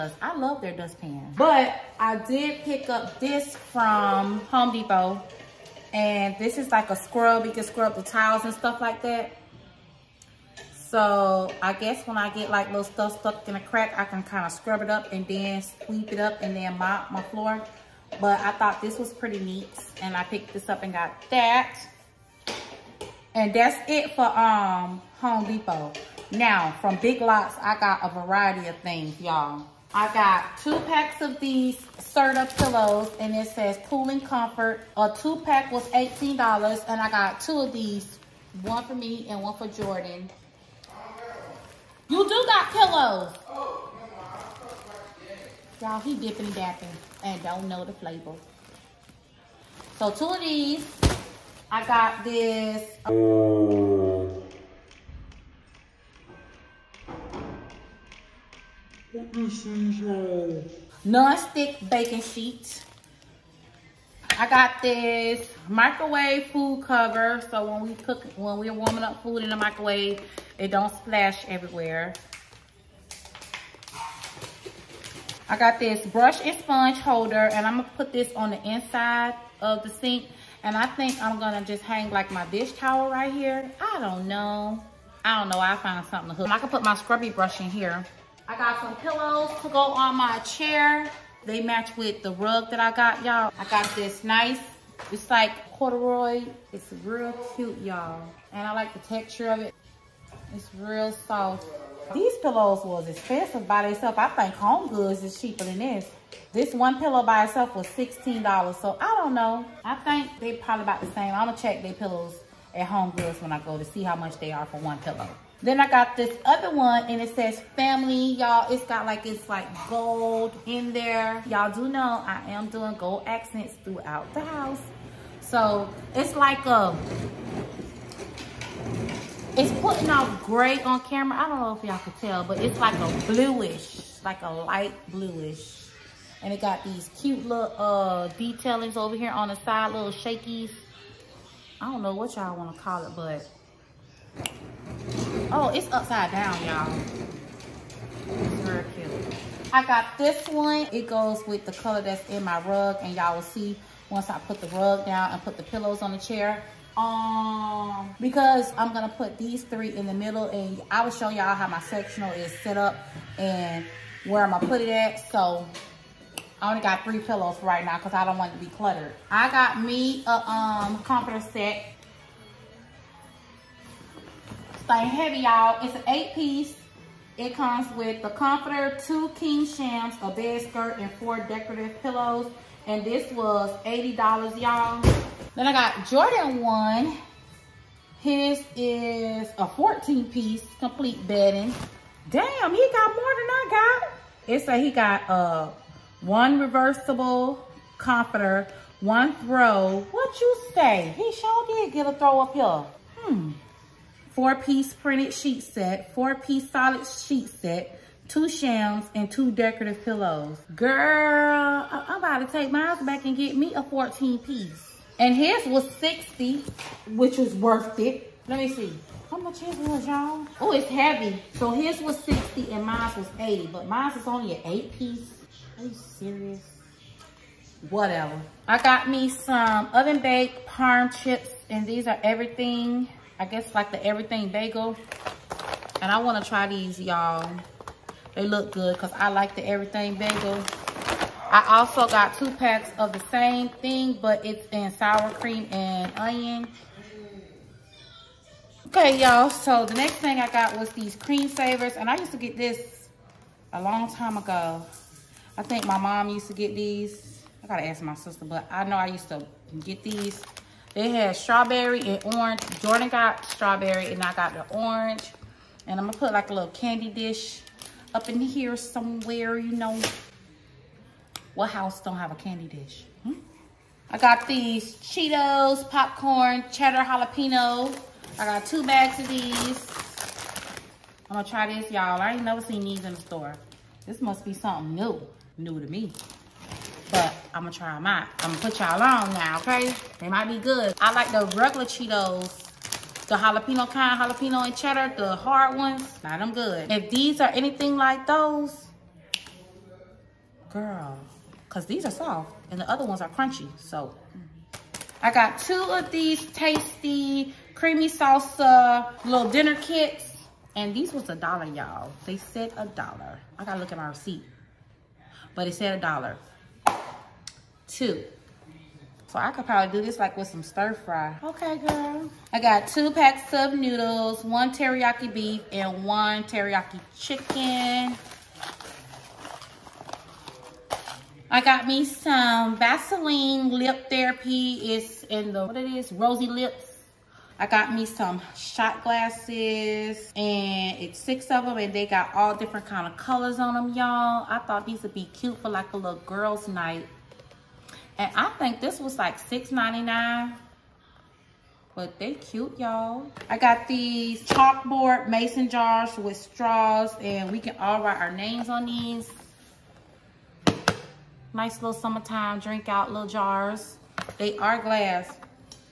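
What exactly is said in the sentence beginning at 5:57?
And we can all write our names on these.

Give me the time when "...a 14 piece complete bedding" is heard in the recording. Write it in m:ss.
3:09.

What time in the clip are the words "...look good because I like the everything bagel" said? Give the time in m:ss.
3:58.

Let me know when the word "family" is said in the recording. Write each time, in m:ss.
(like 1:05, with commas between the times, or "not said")
1:57.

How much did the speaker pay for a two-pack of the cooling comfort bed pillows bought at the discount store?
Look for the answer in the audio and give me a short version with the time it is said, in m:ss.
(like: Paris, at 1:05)
$18, at 0:35.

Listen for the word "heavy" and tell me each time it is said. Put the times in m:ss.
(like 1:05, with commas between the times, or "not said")
2:55, 3:40.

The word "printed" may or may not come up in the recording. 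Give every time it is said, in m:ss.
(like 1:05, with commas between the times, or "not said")
3:24.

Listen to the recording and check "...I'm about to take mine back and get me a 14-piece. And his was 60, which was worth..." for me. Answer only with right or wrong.
right.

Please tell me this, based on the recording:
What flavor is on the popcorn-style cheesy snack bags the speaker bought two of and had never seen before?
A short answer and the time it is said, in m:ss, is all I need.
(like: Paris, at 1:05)
Cheddar jalapeno, at 4:36.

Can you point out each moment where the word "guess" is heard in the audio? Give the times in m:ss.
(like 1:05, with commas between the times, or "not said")
0:11, 3:53.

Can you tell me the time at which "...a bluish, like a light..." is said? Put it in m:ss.
2:12.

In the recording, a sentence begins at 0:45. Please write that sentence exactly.
Y'all, he dipping dapping and don't know the flavor.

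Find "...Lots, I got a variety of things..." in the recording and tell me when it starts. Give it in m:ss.
0:27.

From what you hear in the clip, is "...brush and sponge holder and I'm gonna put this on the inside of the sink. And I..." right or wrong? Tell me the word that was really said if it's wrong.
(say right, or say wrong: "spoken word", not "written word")
right.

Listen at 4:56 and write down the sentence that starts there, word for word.
If these are anything like those, girl, because these are soft and the other ones are crunchy.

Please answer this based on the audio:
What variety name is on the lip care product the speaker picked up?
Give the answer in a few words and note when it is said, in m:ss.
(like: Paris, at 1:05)
Rosy Lips, at 5:36.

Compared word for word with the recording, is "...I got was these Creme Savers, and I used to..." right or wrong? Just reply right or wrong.
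right.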